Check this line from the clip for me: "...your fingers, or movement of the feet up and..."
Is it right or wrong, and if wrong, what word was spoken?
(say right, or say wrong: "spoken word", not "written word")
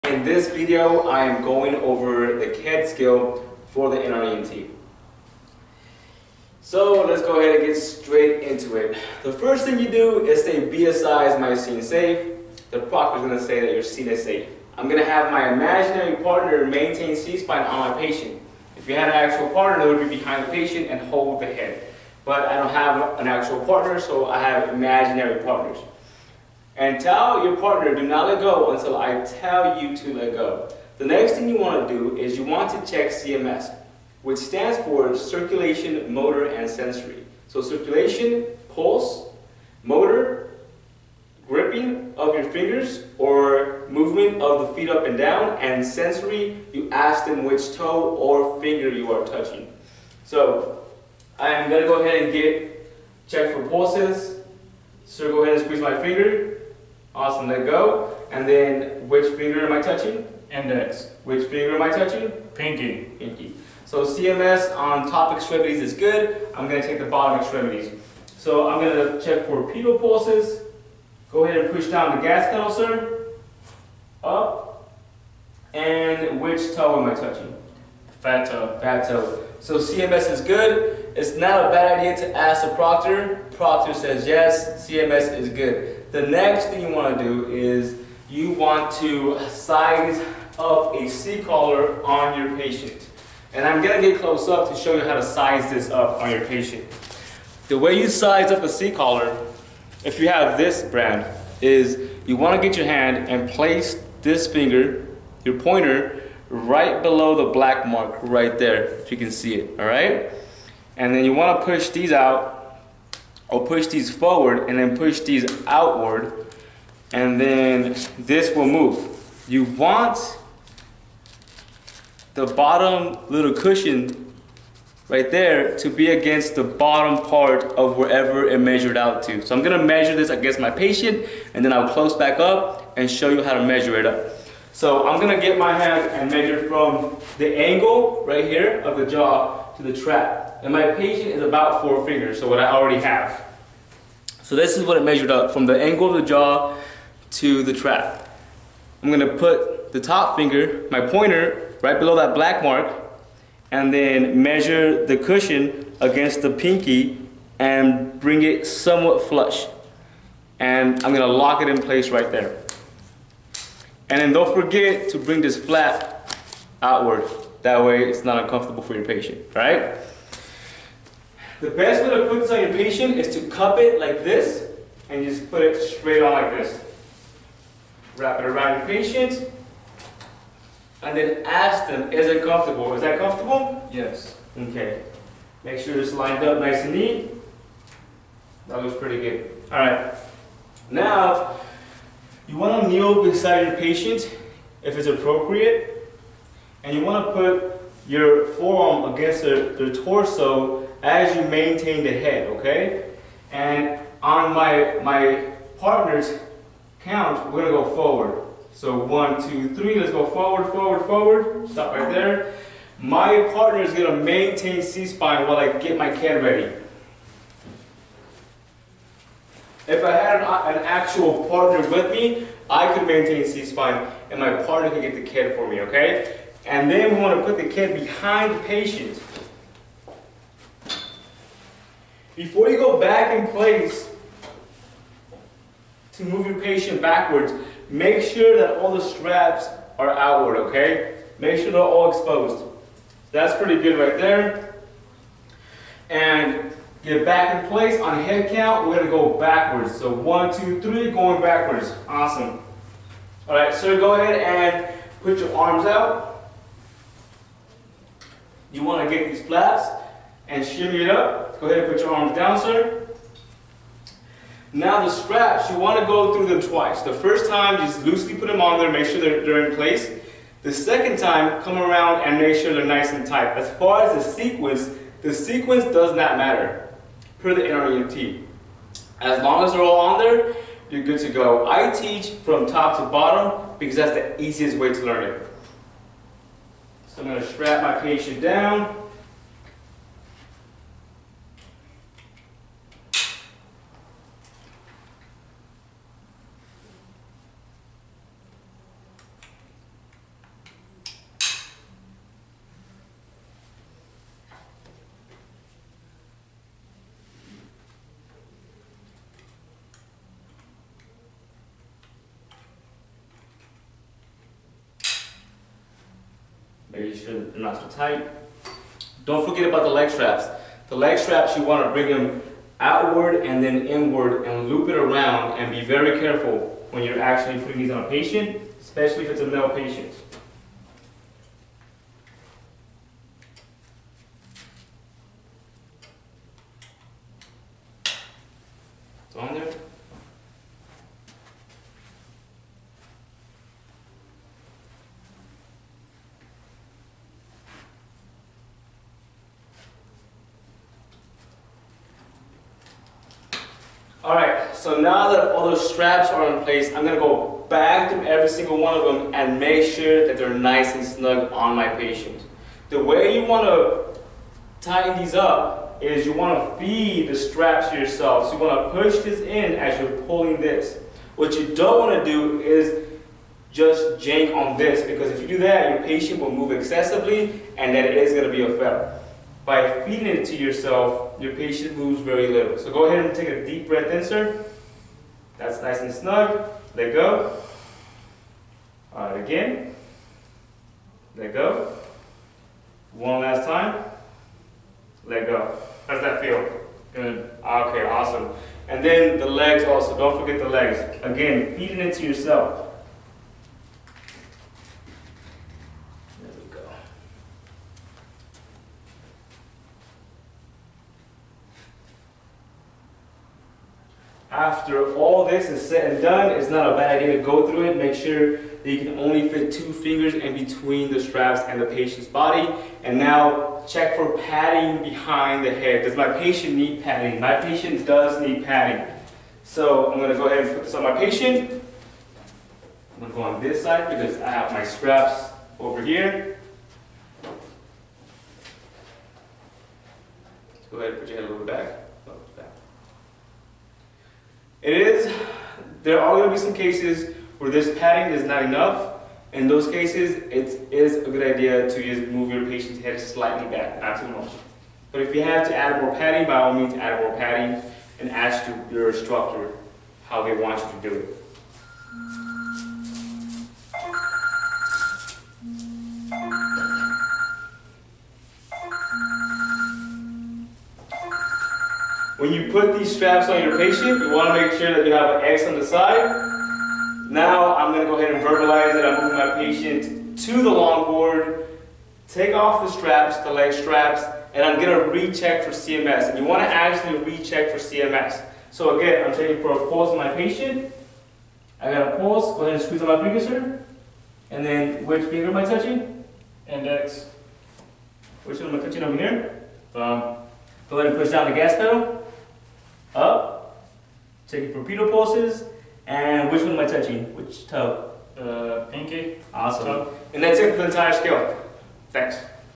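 right.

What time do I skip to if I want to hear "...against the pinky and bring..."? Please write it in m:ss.
2:36.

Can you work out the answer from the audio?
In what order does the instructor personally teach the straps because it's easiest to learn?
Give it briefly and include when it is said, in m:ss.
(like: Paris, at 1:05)
top to bottom, at 4:42.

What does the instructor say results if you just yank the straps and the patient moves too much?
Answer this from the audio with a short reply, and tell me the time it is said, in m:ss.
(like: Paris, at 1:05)
a fail, at 6:18.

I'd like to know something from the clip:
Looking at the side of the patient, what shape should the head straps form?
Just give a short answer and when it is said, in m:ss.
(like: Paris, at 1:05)
an X, at 7:55.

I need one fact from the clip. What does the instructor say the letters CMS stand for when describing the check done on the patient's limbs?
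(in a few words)
circulation, motor, and sensory.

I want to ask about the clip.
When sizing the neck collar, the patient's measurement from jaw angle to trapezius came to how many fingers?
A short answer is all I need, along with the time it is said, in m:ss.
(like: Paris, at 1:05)
4, at 2:21.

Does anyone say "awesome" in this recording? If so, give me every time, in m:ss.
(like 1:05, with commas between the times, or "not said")
0:57, 4:12, 6:38, 8:29.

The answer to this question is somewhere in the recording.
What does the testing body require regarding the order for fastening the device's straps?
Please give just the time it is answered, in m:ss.
4:35.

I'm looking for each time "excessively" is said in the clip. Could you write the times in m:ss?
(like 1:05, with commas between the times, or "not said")
6:16.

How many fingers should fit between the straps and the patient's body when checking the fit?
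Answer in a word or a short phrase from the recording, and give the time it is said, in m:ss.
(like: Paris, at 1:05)
2, at 6:59.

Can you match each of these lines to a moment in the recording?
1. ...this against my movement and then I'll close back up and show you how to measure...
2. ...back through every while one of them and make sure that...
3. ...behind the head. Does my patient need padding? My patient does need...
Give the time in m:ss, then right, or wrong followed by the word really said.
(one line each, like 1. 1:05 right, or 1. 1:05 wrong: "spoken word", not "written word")
1. 2:10 wrong: "patient", not "movement"
2. 5:57 wrong: "single", not "while"
3. 7:05 right.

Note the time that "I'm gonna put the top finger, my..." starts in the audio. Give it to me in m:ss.
2:29.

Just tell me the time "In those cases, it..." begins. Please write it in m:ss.
7:29.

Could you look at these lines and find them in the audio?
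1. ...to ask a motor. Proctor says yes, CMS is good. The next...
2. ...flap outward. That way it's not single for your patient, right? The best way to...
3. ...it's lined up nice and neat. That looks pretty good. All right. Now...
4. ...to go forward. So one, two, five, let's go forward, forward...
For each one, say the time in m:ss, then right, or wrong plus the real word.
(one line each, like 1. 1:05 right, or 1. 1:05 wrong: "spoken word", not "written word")
1. 1:22 wrong: "proctor", not "motor"
2. 2:45 wrong: "uncomfortable", not "single"
3. 3:06 right
4. 3:27 wrong: "three", not "five".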